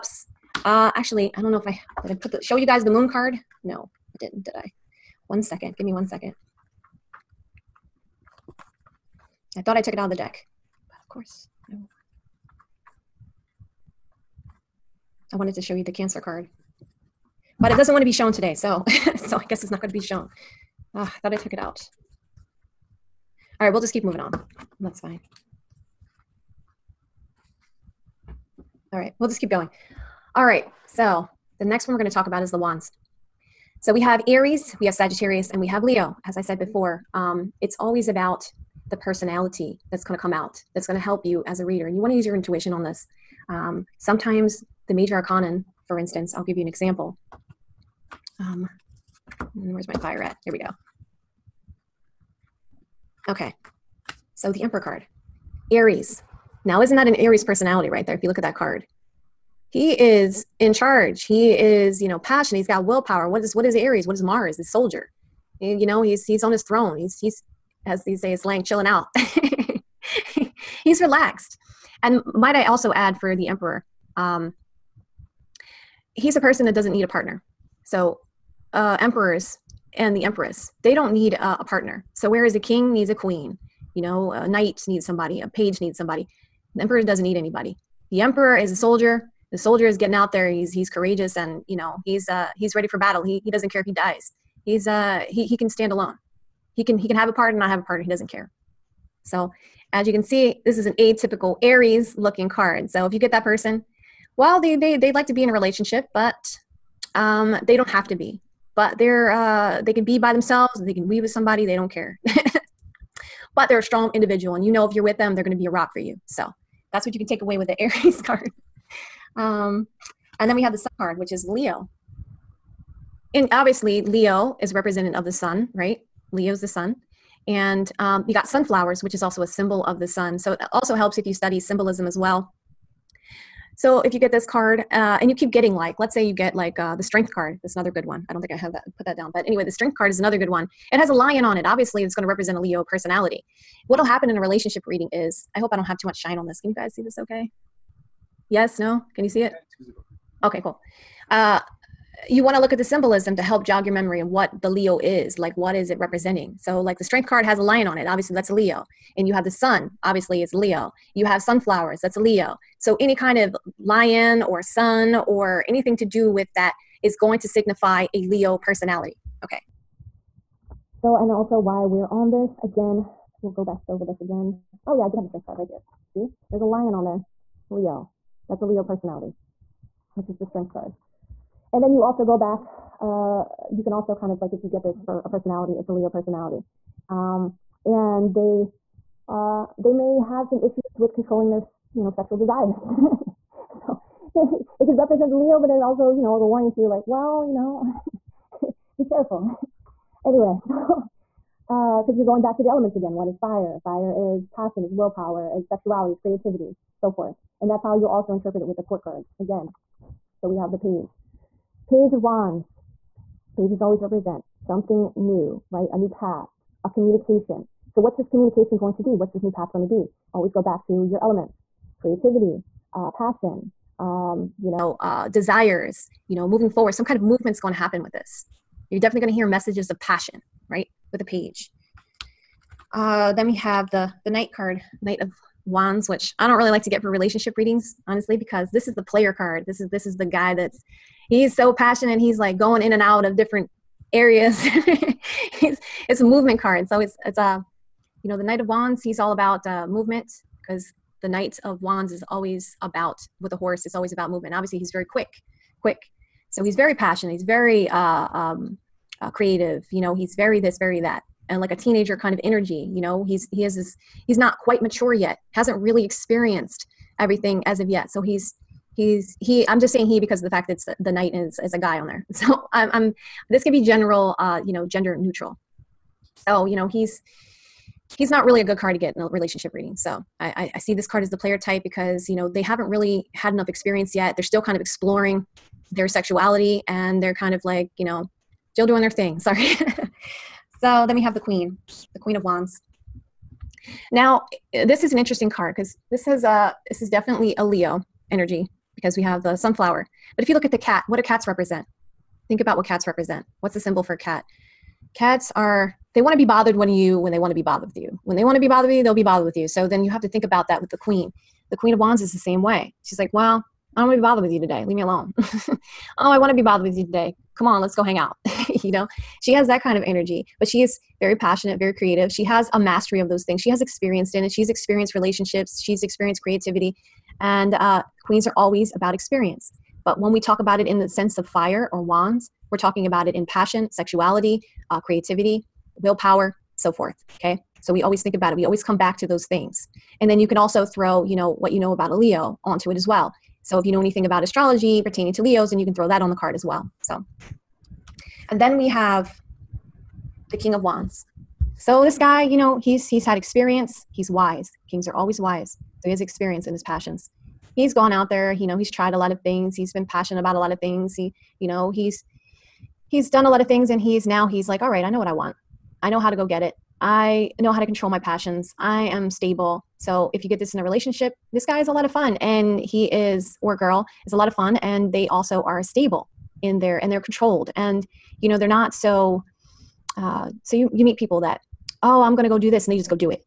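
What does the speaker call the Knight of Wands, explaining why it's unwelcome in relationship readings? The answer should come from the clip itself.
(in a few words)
the player card.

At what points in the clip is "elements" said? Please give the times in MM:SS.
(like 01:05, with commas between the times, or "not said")
03:22, 03:41.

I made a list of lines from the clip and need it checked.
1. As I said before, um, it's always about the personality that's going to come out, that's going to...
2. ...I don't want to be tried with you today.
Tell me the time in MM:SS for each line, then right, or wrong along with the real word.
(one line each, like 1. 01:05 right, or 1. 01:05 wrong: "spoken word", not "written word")
1. 00:36 right
2. 05:13 wrong: "bothered", not "tried".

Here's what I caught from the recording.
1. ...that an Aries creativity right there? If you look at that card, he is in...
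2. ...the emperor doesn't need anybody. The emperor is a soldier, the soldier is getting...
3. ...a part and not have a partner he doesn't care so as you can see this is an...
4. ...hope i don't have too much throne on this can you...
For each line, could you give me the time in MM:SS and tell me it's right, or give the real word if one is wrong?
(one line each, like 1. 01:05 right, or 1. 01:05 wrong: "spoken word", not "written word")
1. 00:56 wrong: "personality", not "creativity"
2. 01:26 right
3. 01:37 right
4. 02:25 wrong: "shine", not "throne".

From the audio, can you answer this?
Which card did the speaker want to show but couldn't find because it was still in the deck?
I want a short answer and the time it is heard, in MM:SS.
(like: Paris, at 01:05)
cancer card, at 00:15.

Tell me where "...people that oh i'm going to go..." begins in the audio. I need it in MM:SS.
06:21.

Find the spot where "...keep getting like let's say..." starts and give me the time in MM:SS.
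02:15.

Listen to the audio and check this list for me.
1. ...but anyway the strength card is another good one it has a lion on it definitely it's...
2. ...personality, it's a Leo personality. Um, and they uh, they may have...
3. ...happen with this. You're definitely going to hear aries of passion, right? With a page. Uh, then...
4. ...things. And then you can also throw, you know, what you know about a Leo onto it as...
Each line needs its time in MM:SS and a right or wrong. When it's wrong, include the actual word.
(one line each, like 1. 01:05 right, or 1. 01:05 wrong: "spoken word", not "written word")
1. 02:19 wrong: "obviously", not "definitely"
2. 03:05 right
3. 03:47 wrong: "messages", not "aries"
4. 05:39 right.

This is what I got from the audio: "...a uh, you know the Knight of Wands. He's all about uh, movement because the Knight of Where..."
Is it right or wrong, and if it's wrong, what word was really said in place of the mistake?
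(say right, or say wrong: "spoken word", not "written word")
wrong: "Wands", not "Where".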